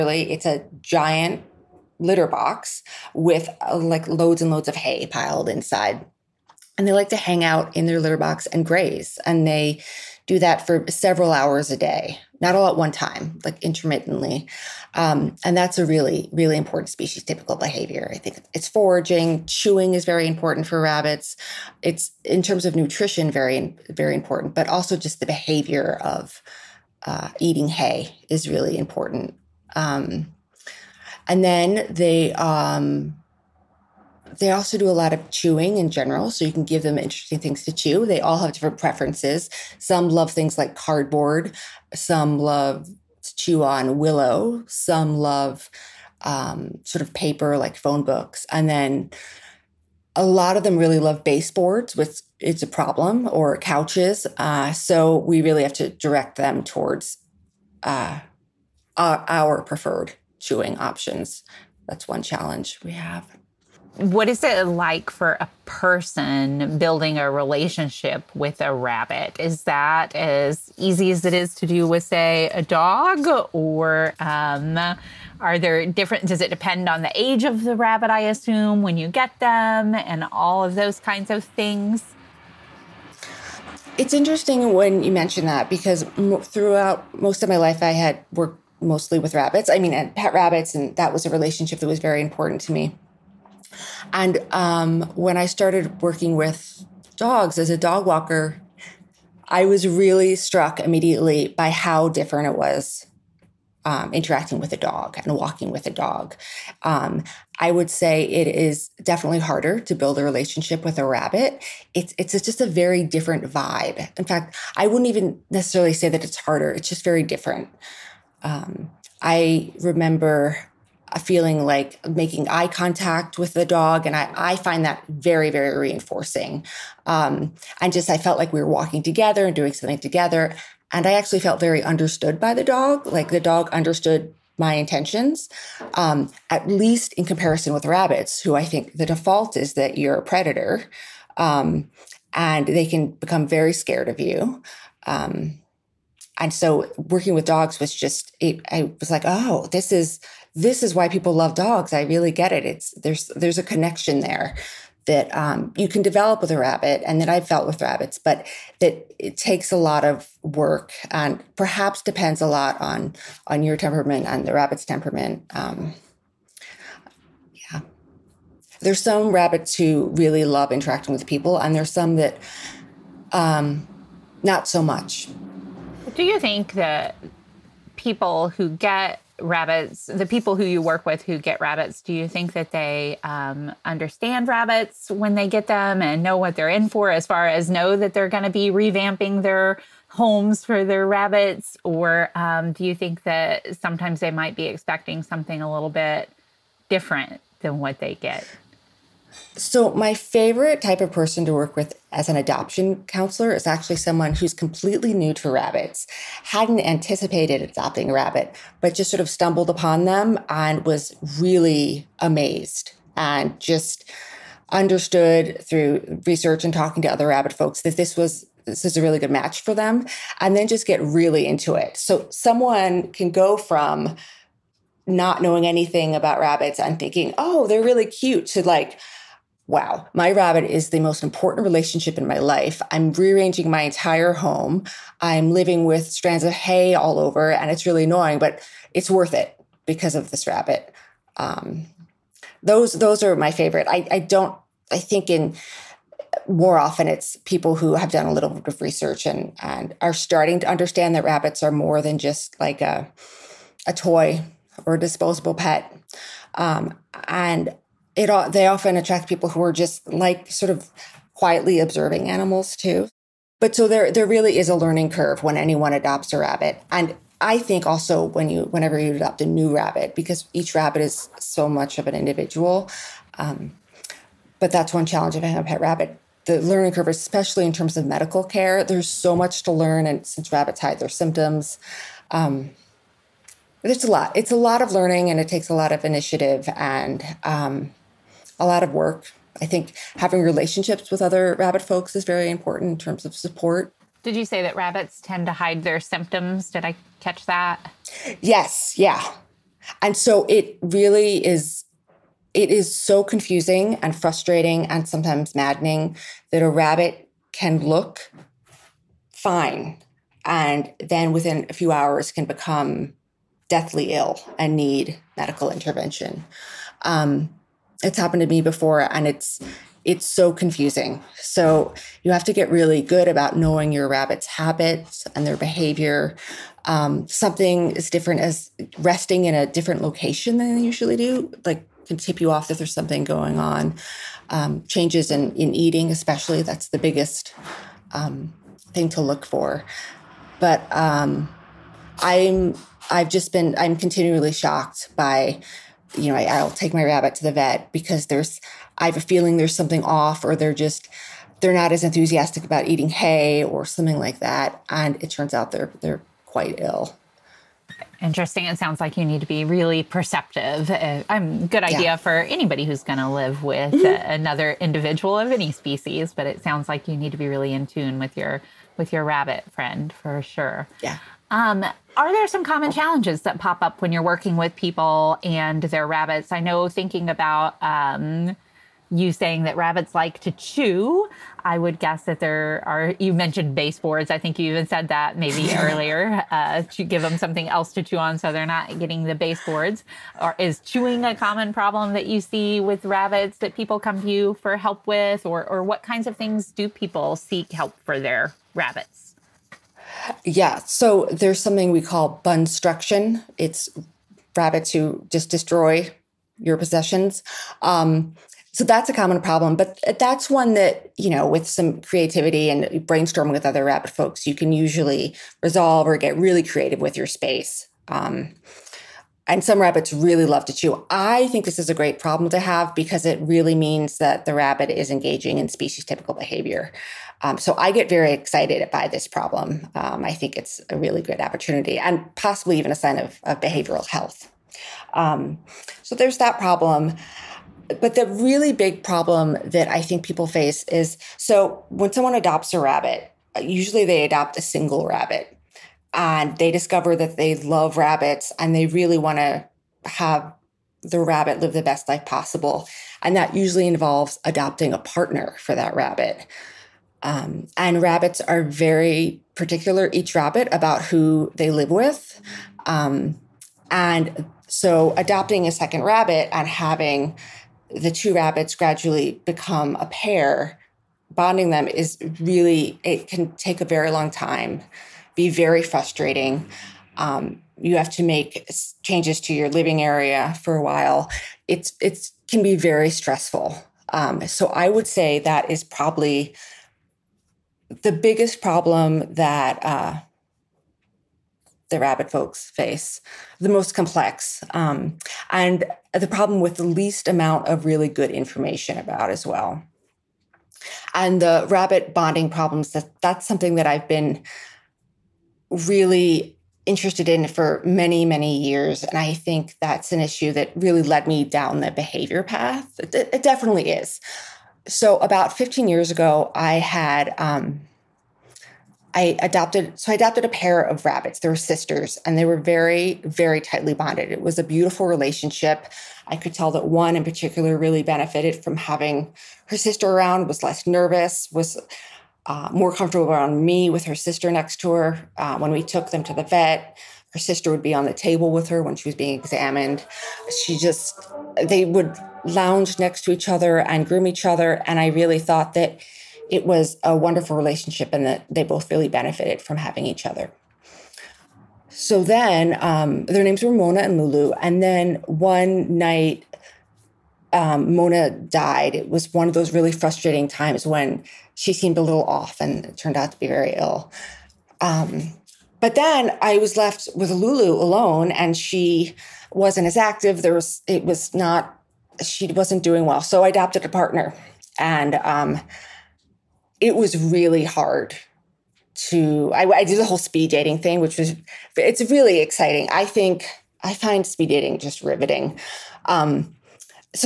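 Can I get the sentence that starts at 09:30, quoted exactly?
There was it was not she wasn't doing well.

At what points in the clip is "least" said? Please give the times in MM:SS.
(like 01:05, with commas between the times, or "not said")
02:16, 08:16.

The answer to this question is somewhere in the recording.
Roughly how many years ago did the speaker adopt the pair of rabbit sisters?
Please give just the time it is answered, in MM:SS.
08:35.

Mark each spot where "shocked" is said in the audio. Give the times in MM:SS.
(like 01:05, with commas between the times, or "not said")
05:44.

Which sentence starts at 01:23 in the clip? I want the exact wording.
It's interesting when you mention that because throughout most of my life, I had worked mostly with rabbits.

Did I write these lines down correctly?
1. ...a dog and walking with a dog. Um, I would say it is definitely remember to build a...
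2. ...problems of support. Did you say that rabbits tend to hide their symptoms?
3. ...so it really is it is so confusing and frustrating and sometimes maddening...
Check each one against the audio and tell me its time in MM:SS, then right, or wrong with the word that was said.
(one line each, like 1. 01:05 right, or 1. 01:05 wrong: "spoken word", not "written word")
1. 01:44 wrong: "harder", not "remember"
2. 04:52 wrong: "terms", not "problems"
3. 05:00 right.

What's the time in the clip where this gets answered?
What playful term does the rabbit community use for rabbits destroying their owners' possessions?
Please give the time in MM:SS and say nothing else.
06:42.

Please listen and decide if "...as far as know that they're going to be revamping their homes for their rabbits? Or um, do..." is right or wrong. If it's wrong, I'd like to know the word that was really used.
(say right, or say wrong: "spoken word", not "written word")
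right.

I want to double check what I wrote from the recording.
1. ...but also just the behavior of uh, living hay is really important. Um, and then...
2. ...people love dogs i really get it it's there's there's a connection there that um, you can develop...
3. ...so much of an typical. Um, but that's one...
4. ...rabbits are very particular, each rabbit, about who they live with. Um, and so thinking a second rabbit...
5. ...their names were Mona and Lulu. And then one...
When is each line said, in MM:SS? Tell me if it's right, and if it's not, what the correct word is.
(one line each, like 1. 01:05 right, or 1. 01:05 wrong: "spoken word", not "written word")
1. 00:24 wrong: "eating", not "living"
2. 02:31 right
3. 04:31 wrong: "individual", not "typical"
4. 07:37 wrong: "adopting", not "thinking"
5. 09:13 right.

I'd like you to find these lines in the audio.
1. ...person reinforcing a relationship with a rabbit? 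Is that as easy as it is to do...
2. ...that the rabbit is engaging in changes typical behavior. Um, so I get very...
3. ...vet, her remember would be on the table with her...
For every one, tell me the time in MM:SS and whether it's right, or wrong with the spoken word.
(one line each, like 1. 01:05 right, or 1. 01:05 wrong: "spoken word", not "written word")
1. 01:05 wrong: "building", not "reinforcing"
2. 07:04 wrong: "species", not "changes"
3. 08:56 wrong: "sister", not "remember".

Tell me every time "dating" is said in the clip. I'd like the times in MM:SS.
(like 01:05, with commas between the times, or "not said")
09:40, 09:44.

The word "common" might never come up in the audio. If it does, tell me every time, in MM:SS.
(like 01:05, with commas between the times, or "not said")
06:12, 06:31, 06:49.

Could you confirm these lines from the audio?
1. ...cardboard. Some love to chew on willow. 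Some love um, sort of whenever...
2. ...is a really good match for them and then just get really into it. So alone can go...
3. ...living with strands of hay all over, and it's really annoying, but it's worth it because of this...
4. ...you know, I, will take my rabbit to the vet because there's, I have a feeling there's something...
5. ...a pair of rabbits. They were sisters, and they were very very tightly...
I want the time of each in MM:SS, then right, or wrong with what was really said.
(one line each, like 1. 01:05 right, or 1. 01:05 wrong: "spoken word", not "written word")
1. 00:40 wrong: "paper", not "whenever"
2. 03:38 wrong: "someone", not "alone"
3. 03:55 right
4. 05:46 right
5. 08:40 right.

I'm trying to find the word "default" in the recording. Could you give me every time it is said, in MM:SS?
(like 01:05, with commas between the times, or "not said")
02:19.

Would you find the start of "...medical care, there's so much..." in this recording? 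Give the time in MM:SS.
04:38.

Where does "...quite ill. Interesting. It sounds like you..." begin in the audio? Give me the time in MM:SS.
05:56.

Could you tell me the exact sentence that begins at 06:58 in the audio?
Um, and some rabbits really love to chew.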